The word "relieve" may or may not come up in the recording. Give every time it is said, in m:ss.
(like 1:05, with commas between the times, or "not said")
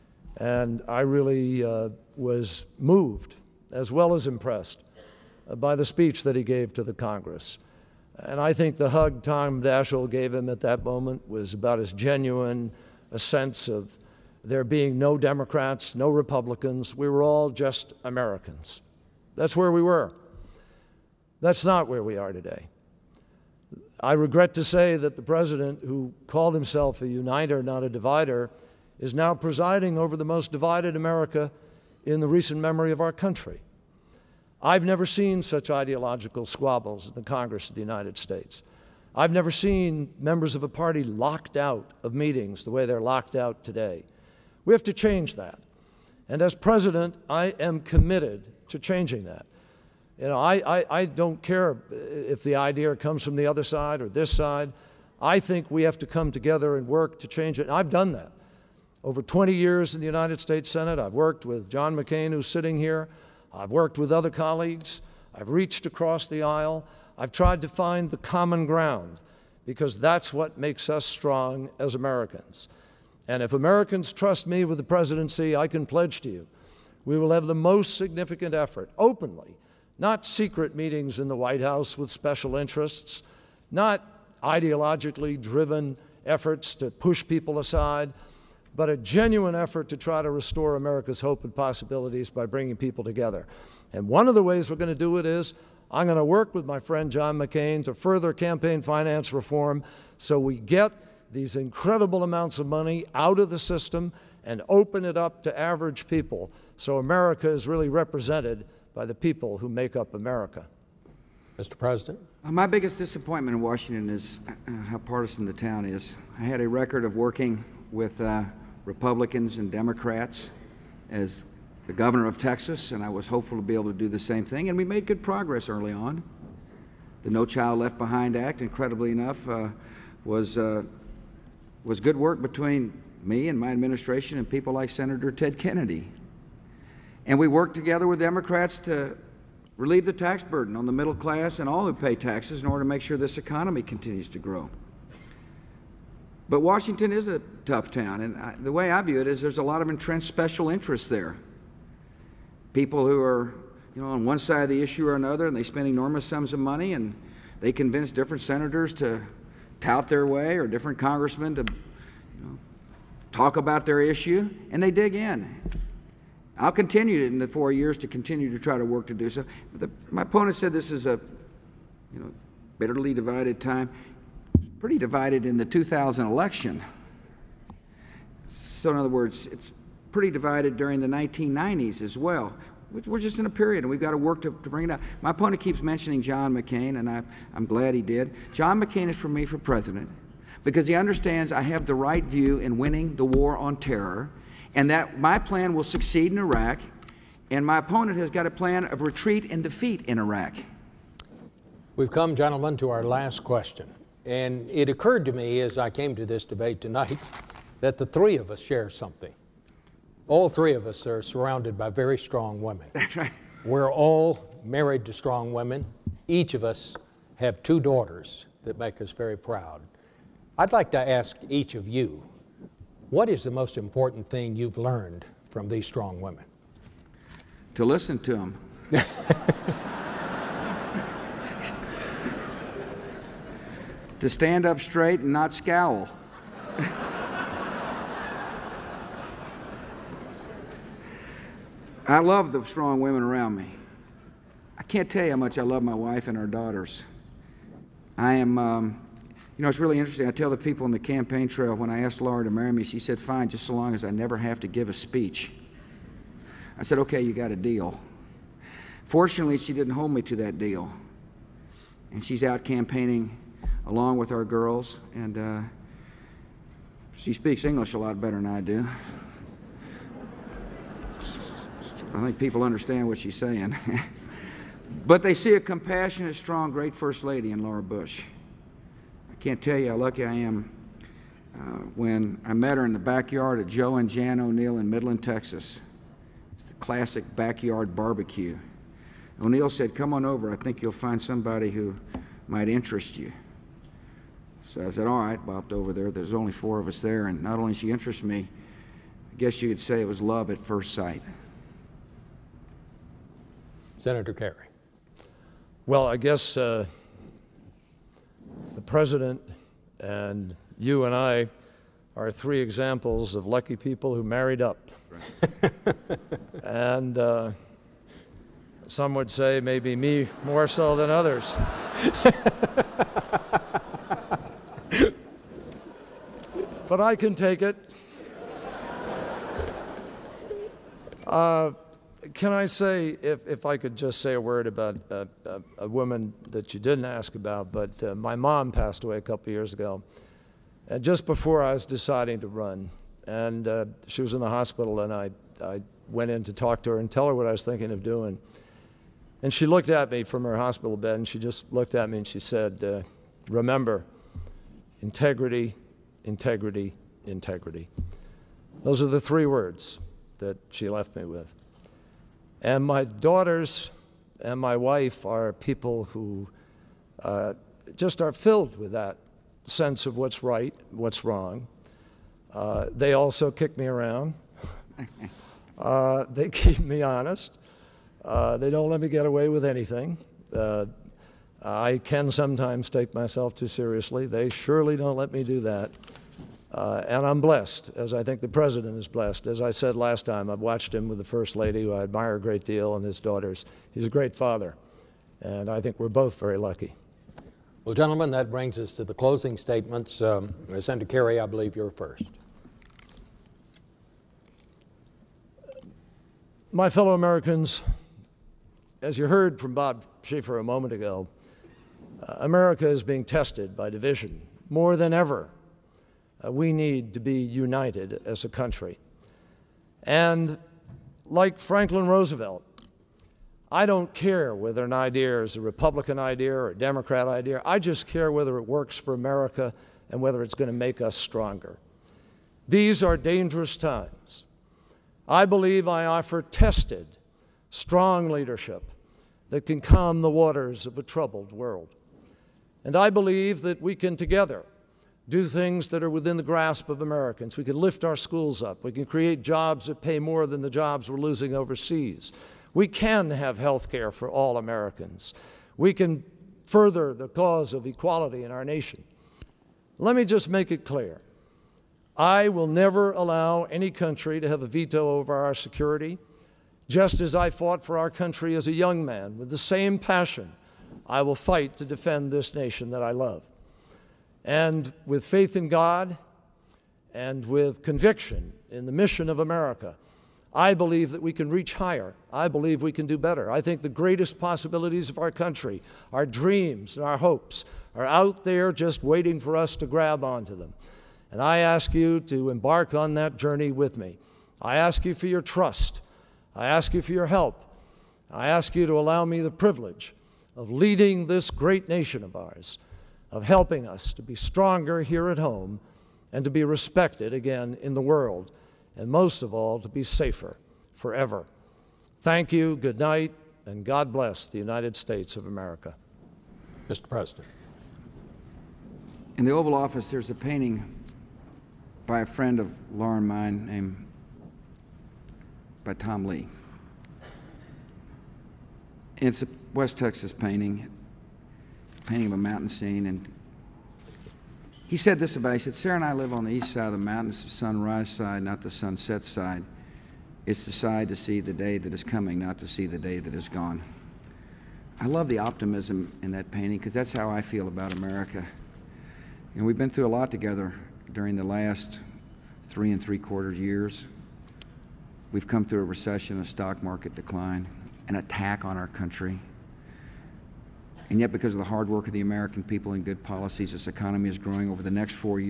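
2:19.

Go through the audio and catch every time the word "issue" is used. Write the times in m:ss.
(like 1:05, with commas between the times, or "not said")
2:34, 2:43.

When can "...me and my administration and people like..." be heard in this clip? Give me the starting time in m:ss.
2:13.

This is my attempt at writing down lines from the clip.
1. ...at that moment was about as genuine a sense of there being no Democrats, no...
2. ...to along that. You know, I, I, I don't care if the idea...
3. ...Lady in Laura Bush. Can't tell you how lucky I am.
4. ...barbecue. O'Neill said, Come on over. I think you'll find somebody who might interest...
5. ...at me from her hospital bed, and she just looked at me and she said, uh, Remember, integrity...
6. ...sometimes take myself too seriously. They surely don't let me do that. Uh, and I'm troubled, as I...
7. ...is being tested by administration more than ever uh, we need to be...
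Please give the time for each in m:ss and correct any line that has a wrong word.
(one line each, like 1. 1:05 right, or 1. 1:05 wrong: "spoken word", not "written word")
1. 0:10 right
2. 0:48 wrong: "changing", not "along"
3. 4:37 right
4. 4:47 right
5. 5:49 right
6. 6:22 wrong: "blessed", not "troubled"
7. 6:52 wrong: "division", not "administration".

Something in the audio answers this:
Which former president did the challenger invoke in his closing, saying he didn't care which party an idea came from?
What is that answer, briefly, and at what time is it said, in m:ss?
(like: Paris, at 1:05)
Franklin Roosevelt, at 7:01.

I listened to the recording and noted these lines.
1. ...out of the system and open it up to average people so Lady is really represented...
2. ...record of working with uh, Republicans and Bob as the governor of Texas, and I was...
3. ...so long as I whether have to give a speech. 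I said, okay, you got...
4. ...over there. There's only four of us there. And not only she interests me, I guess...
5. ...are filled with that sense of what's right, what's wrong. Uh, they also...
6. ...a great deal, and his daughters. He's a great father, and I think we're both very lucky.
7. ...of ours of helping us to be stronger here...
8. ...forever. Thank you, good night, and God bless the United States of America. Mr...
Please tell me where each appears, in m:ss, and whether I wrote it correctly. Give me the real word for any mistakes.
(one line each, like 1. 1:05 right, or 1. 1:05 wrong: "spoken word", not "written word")
1. 1:43 wrong: "America", not "Lady"
2. 1:56 wrong: "Democrats", not "Bob"
3. 4:13 wrong: "never", not "whether"
4. 4:55 right
5. 6:08 right
6. 6:32 right
7. 8:22 right
8. 8:30 right.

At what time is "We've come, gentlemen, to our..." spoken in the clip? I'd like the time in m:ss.
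3:21.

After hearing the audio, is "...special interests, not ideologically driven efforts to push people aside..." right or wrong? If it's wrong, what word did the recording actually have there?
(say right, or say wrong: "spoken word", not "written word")
right.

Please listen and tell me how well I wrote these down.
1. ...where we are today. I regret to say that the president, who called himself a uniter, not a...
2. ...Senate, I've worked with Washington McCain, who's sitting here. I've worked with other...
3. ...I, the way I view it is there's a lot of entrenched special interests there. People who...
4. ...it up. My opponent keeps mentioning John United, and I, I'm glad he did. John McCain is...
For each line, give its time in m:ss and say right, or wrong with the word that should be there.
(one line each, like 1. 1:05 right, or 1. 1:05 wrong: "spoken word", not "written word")
1. 0:21 right
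2. 1:00 wrong: "John", not "Washington"
3. 2:28 right
4. 3:04 wrong: "McCain", not "United".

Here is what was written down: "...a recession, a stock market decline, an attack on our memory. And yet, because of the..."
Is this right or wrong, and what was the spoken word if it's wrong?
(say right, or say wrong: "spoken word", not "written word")
wrong: "country", not "memory".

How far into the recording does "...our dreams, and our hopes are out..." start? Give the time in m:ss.
8:06.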